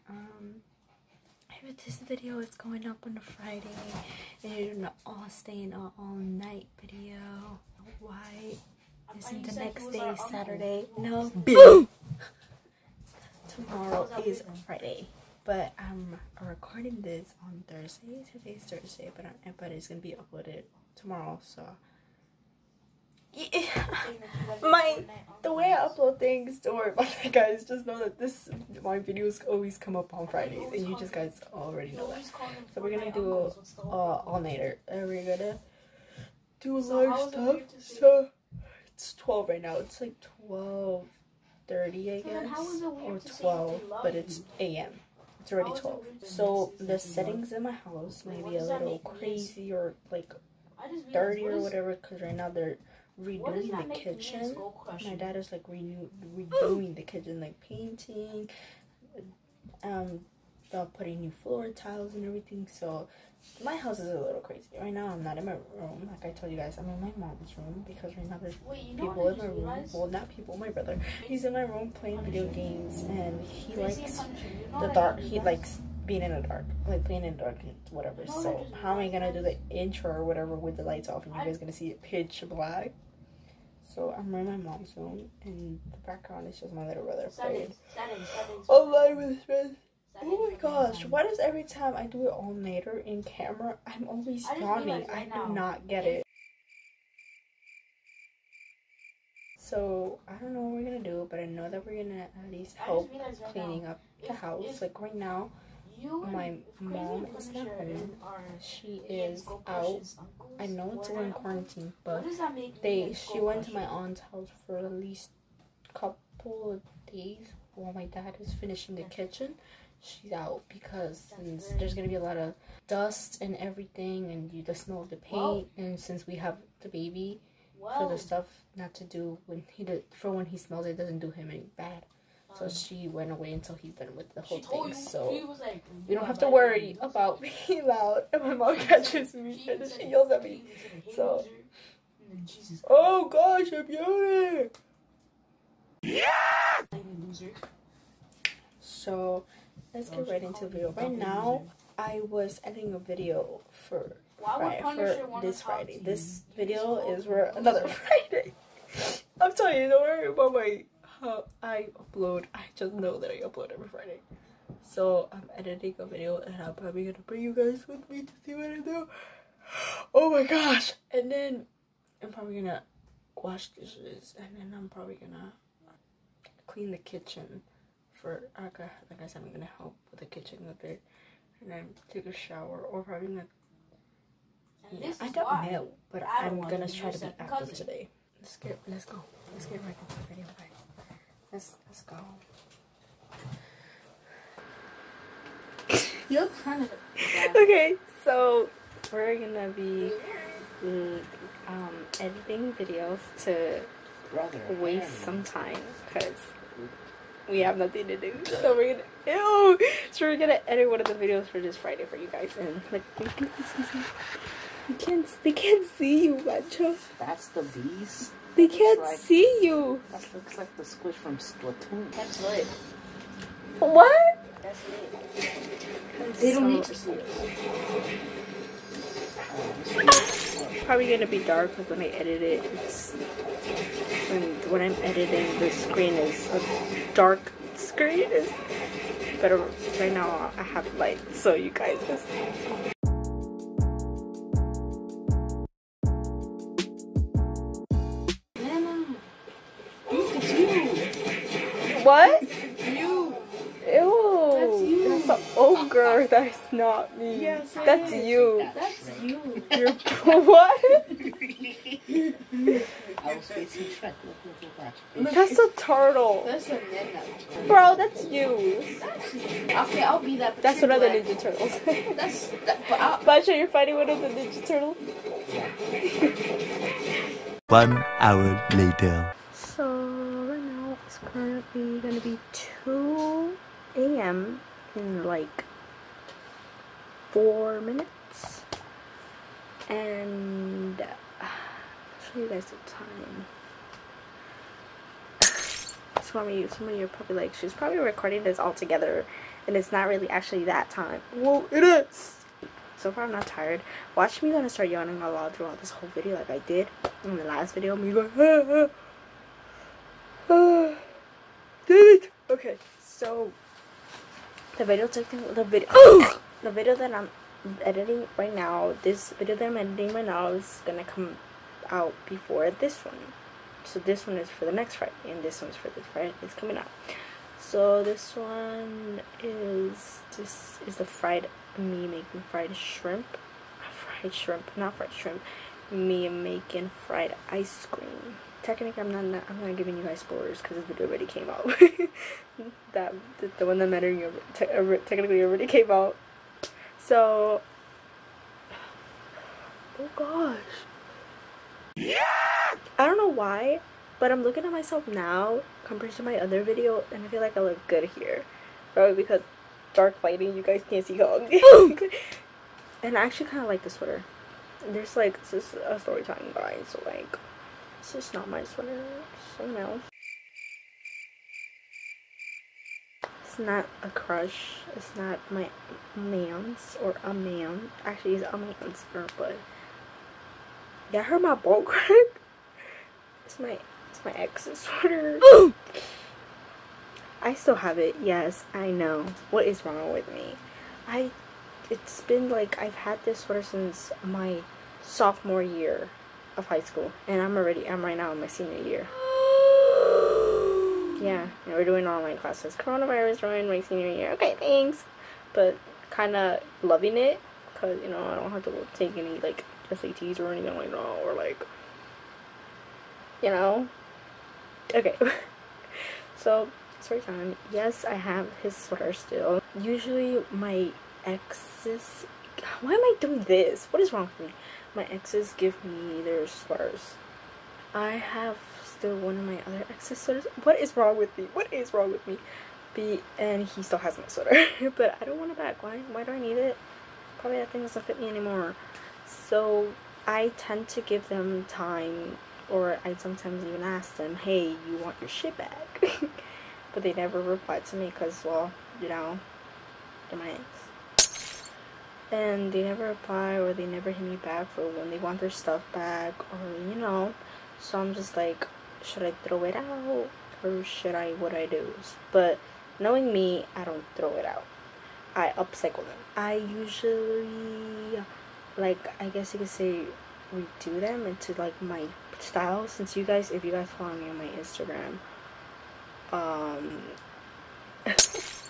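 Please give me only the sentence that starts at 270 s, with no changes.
That's one of the Ninja Turtles.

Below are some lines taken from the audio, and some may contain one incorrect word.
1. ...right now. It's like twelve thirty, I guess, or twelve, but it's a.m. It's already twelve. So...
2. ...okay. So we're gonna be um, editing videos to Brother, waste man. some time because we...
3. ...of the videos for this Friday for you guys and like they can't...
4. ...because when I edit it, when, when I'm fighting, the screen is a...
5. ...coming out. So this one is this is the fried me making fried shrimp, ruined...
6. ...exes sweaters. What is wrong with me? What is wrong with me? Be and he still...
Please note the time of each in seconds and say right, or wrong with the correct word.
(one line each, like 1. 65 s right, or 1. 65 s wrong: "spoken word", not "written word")
1. 39 s right
2. 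197 s right
3. 211 s right
4. 231 s wrong: "editing", not "fighting"
5. 326 s wrong: "fried", not "ruined"
6. 429 s right.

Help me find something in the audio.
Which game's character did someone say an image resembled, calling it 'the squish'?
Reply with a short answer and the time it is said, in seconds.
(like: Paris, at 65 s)
Splatoon, at 221 s.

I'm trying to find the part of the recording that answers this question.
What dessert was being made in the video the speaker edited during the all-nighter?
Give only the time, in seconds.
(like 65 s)
337 s.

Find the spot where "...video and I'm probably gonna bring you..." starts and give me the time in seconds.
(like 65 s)
166 s.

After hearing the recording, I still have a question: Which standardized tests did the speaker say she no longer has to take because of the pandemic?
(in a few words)
SATs.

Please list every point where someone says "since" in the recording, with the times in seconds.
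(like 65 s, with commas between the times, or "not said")
125 s, 393 s, 472 s.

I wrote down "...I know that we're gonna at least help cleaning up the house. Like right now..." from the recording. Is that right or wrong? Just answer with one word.
right.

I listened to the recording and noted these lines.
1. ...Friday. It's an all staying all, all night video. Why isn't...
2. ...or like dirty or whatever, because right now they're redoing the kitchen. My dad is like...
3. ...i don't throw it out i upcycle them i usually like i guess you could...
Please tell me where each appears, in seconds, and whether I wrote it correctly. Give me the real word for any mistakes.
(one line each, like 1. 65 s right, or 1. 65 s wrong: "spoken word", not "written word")
1. 3 s right
2. 49 s right
3. 463 s right.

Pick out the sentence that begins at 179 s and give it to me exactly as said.
Uh, I said I'm gonna help with the kitchen a bit and then take a shower or probably gonna.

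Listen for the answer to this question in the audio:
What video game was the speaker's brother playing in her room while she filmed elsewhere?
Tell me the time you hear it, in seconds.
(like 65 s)
72 s.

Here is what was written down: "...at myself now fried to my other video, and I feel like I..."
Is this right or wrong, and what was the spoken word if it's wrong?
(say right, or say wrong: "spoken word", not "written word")
wrong: "compared", not "fried".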